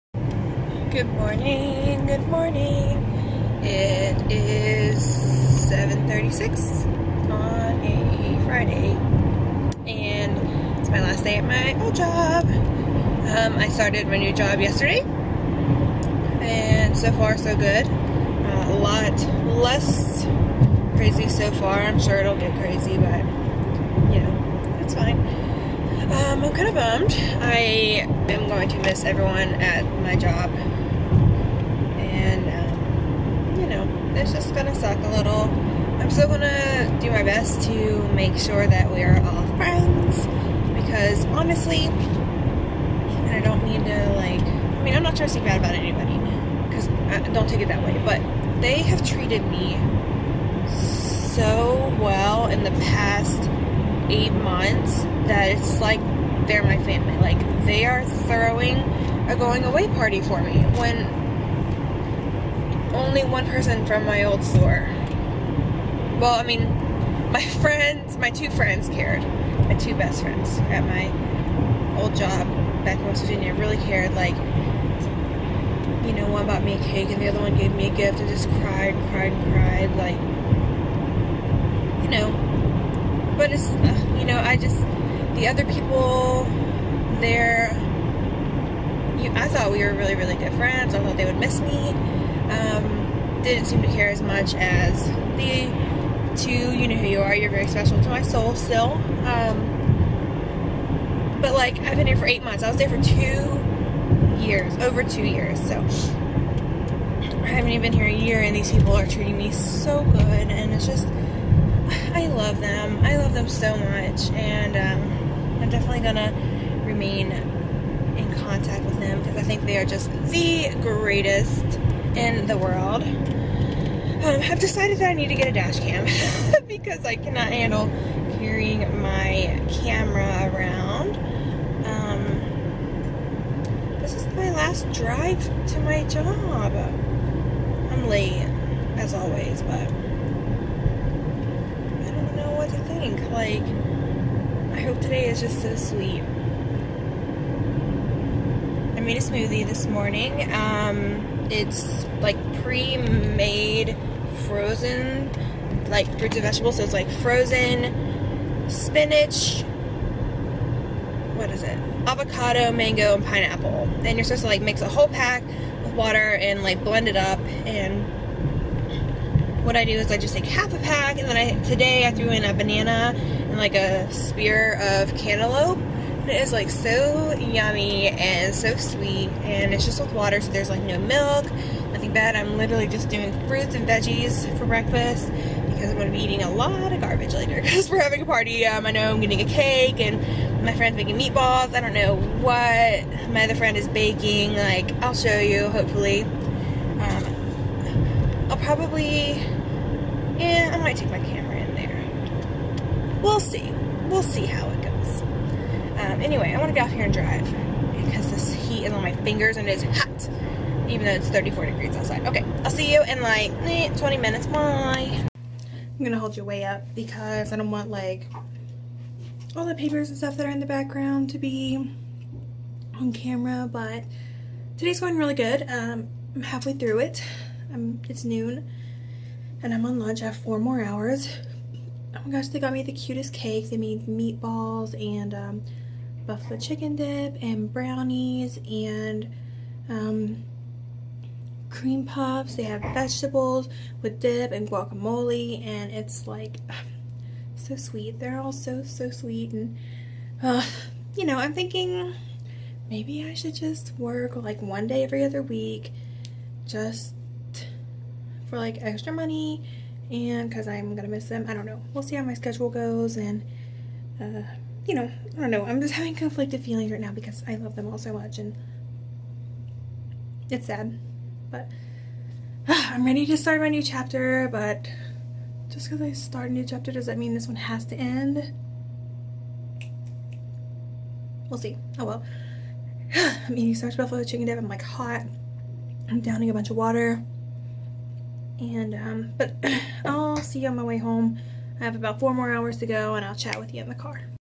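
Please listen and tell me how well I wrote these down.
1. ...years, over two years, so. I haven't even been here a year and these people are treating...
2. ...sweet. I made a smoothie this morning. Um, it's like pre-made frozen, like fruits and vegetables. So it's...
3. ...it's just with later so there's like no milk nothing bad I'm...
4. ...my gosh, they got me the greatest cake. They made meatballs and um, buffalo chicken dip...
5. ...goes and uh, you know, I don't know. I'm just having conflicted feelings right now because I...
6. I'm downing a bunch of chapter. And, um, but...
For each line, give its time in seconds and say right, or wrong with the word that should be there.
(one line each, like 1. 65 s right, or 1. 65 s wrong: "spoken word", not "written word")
1. 104 s right
2. 145 s right
3. 179 s wrong: "water", not "later"
4. 232 s wrong: "cutest", not "greatest"
5. 262 s right
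6. 286 s wrong: "water", not "chapter".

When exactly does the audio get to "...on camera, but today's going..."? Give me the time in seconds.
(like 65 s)
222 s.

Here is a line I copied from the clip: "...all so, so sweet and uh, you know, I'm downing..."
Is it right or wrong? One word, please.
wrong.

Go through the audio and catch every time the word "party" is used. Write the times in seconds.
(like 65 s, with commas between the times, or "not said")
59 s, 188 s.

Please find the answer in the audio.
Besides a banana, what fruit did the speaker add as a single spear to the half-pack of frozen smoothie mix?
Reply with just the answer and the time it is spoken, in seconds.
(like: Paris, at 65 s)
Cantaloupe, at 175 s.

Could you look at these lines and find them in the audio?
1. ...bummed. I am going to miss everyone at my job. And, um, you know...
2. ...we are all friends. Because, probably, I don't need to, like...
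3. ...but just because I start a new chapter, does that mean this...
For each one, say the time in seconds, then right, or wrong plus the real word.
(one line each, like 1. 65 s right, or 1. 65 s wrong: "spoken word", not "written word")
1. 26 s right
2. 38 s wrong: "honestly", not "probably"
3. 274 s right.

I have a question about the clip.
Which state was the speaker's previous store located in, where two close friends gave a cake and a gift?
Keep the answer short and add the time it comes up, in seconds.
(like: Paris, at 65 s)
West Virginia, at 73 s.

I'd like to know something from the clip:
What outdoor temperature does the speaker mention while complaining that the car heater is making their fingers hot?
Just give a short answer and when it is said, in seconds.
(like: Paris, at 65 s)
34 degrees, at 211 s.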